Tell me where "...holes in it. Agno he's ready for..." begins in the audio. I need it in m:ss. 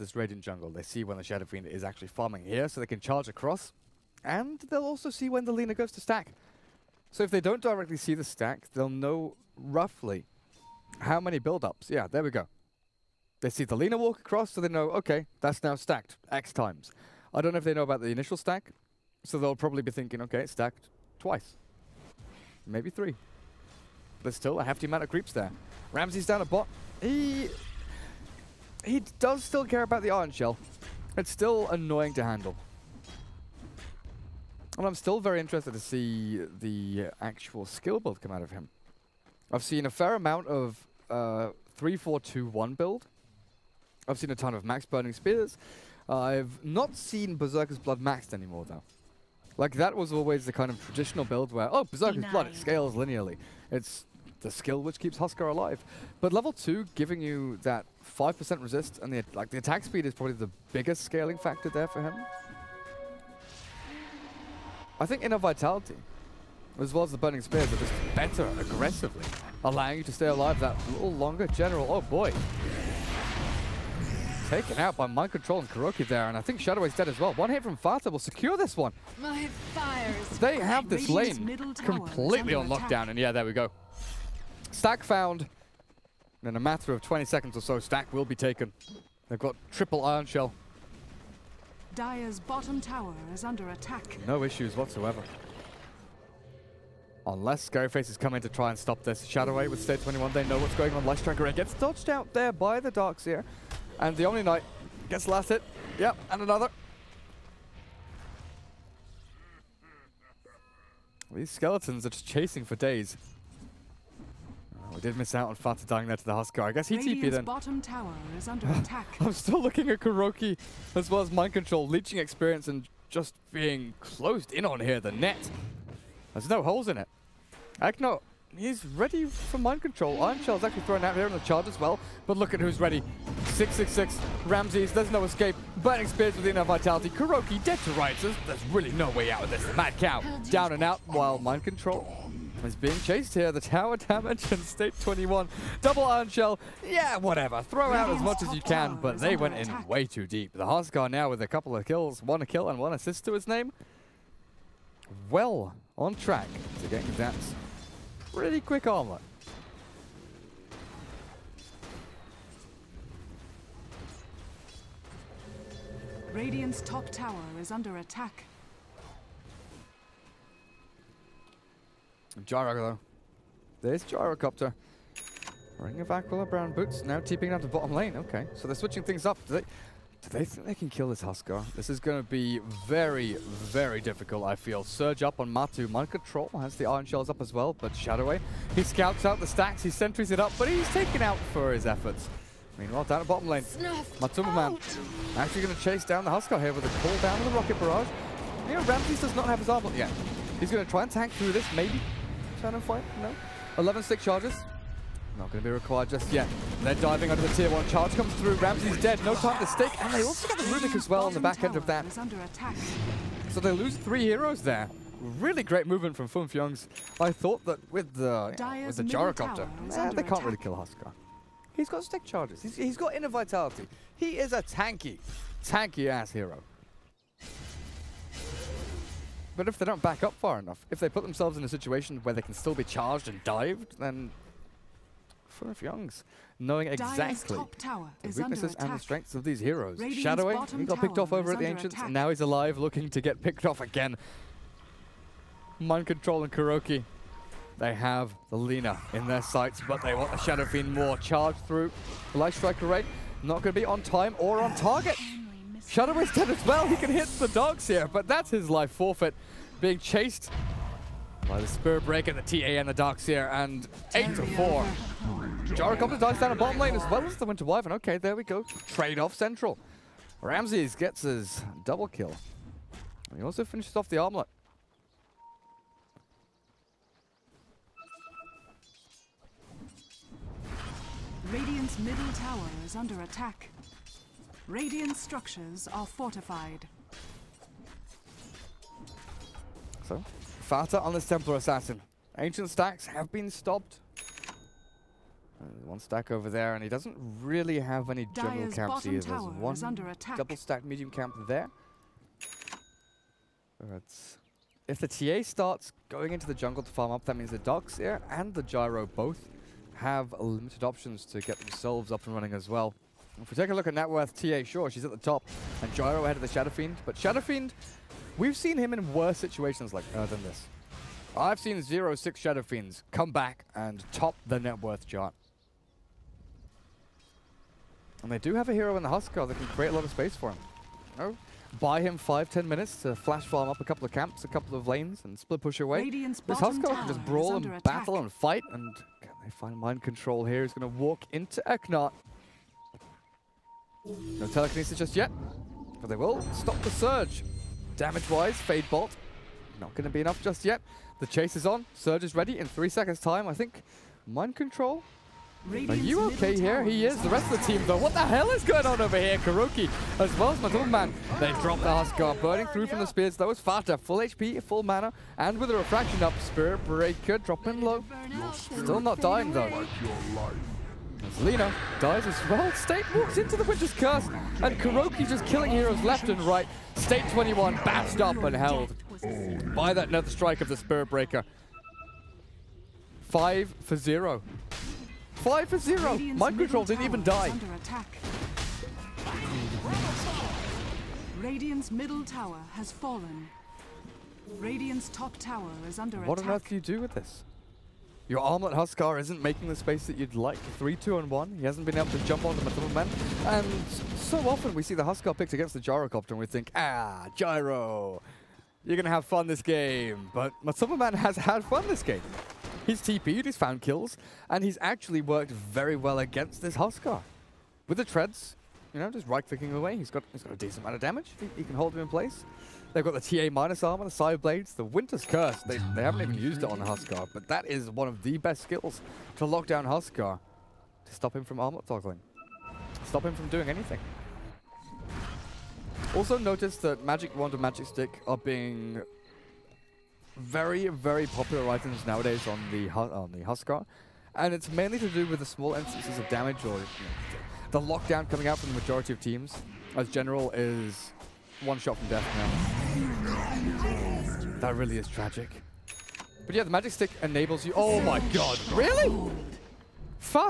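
2:06.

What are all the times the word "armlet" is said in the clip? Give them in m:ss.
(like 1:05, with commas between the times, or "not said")
4:34, 6:38.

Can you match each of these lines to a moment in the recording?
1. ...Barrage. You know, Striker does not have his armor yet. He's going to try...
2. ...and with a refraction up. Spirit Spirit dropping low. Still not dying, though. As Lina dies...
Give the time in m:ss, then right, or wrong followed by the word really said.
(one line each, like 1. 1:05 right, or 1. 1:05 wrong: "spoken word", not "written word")
1. 3:17 wrong: "Ramzes", not "Striker"
2. 6:05 wrong: "Breaker", not "Spirit".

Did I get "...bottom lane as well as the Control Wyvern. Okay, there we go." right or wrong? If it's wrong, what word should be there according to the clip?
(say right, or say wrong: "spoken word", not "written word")
wrong: "Winter", not "Control".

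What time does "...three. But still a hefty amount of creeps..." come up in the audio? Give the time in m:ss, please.
0:22.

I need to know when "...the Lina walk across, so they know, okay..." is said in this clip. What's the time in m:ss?
0:13.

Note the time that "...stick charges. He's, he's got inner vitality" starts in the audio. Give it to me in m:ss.
3:42.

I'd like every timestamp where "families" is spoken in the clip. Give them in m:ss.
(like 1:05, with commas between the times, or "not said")
not said.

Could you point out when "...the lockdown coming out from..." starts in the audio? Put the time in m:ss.
7:27.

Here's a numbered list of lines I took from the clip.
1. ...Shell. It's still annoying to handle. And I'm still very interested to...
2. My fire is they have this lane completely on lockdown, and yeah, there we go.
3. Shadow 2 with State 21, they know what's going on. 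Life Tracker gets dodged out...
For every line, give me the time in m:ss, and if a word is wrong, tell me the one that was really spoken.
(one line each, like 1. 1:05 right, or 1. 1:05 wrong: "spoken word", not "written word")
1. 0:30 right
2. 1:19 right
3. 1:39 wrong: "8", not "2".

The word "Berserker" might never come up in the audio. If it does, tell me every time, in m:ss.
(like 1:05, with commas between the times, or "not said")
0:47, 0:51.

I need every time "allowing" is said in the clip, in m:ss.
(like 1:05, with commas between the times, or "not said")
1:09.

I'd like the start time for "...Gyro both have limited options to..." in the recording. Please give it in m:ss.
5:08.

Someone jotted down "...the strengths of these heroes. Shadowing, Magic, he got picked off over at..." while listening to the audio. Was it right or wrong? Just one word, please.
wrong.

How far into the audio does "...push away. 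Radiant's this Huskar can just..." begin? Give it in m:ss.
5:35.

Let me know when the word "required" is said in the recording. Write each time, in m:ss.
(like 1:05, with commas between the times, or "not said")
3:25.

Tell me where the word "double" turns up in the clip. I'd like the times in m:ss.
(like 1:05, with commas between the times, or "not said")
2:25, 4:31, 5:00.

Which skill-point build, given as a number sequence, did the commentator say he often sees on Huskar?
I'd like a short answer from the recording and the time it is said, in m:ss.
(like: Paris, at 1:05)
3-4-2-1, at 0:41.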